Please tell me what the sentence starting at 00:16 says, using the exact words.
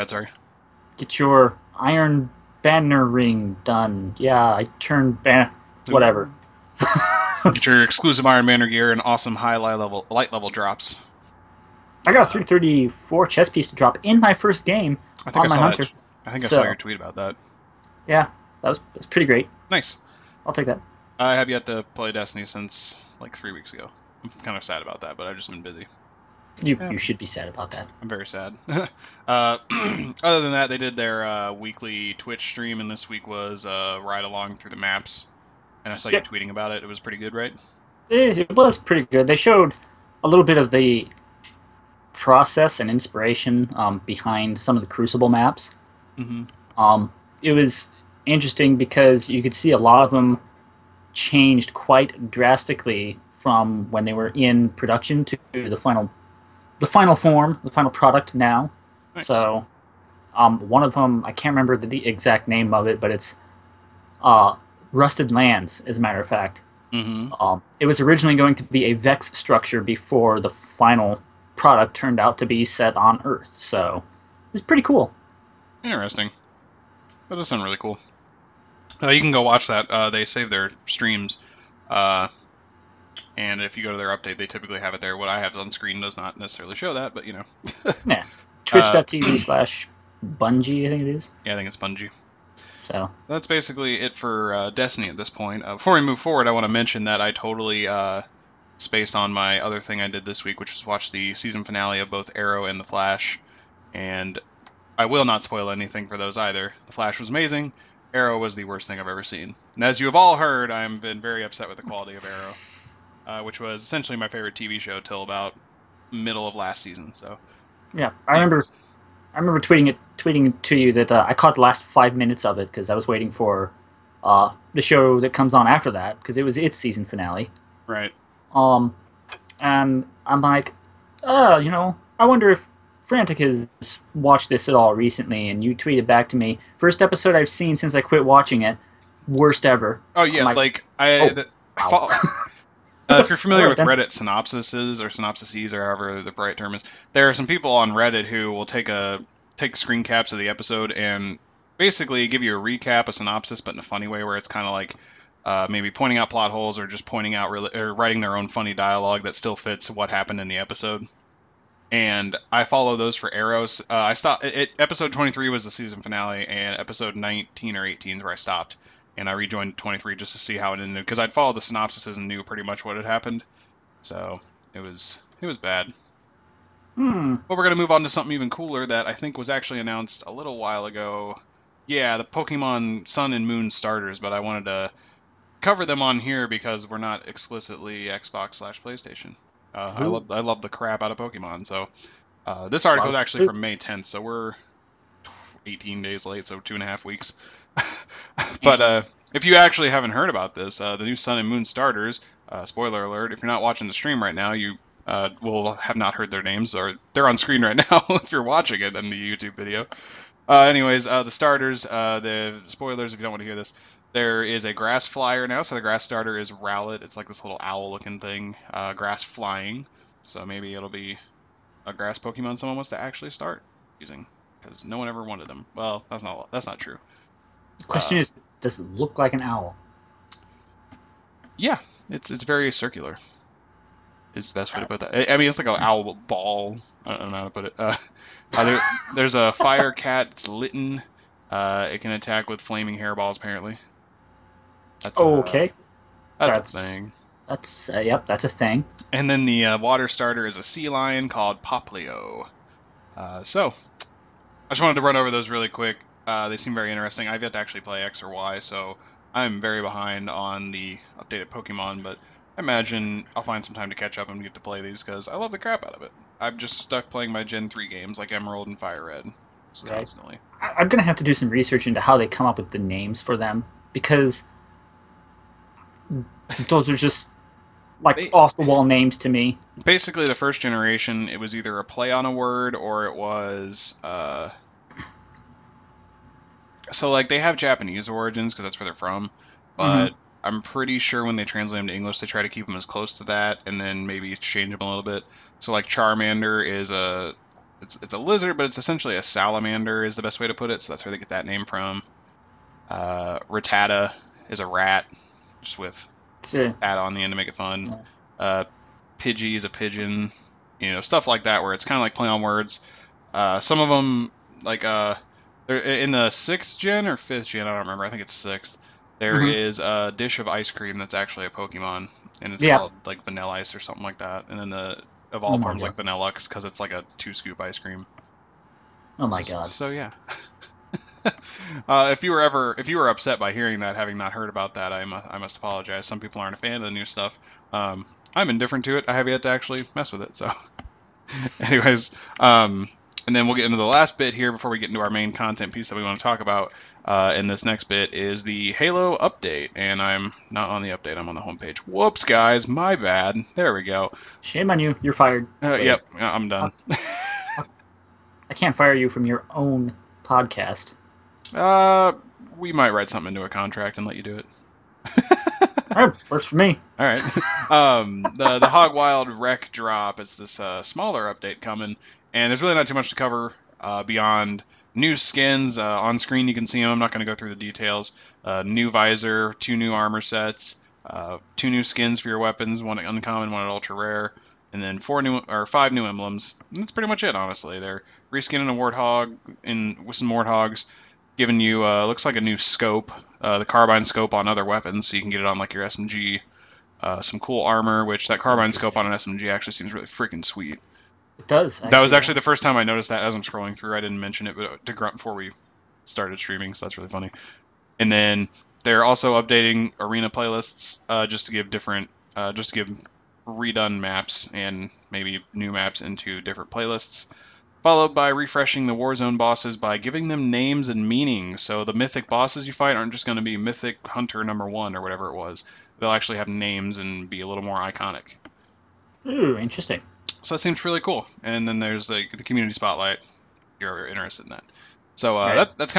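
I think I so, saw your tweet about that.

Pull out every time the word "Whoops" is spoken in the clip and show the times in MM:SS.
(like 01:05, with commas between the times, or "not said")
05:51.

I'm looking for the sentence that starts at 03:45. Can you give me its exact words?
Well, that's not that's not true.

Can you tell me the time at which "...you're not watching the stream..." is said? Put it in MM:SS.
03:23.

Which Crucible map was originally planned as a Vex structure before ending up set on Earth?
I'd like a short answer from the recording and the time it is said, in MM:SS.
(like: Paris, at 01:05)
Rusted Lands, at 01:04.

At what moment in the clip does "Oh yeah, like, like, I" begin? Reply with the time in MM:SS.
02:20.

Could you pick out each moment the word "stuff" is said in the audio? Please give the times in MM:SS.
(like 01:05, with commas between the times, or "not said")
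05:11, 05:37.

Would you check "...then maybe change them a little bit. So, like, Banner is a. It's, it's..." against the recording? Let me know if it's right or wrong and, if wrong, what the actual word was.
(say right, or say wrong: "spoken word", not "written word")
wrong: "Charmander", not "Banner".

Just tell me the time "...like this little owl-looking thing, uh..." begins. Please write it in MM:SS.
03:37.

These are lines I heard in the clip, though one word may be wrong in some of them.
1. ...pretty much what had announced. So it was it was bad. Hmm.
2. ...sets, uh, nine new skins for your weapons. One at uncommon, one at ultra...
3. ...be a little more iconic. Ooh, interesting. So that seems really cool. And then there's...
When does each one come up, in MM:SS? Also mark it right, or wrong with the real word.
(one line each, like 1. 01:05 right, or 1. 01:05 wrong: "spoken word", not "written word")
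1. 02:52 wrong: "happened", not "announced"
2. 06:20 wrong: "two", not "nine"
3. 07:07 right.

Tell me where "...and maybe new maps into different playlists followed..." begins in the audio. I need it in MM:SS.
06:54.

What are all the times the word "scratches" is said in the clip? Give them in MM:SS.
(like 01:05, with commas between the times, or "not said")
not said.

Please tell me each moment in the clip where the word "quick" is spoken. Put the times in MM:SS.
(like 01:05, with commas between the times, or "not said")
04:15.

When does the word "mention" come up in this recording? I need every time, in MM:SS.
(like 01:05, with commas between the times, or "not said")
01:36, 06:44.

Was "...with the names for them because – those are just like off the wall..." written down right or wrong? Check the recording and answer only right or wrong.
right.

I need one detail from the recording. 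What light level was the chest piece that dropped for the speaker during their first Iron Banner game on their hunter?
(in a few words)
334.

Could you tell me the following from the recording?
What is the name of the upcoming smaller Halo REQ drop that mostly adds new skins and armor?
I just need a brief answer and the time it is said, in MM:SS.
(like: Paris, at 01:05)
Hog Wild, at 06:08.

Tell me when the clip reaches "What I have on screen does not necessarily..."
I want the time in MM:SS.
01:25.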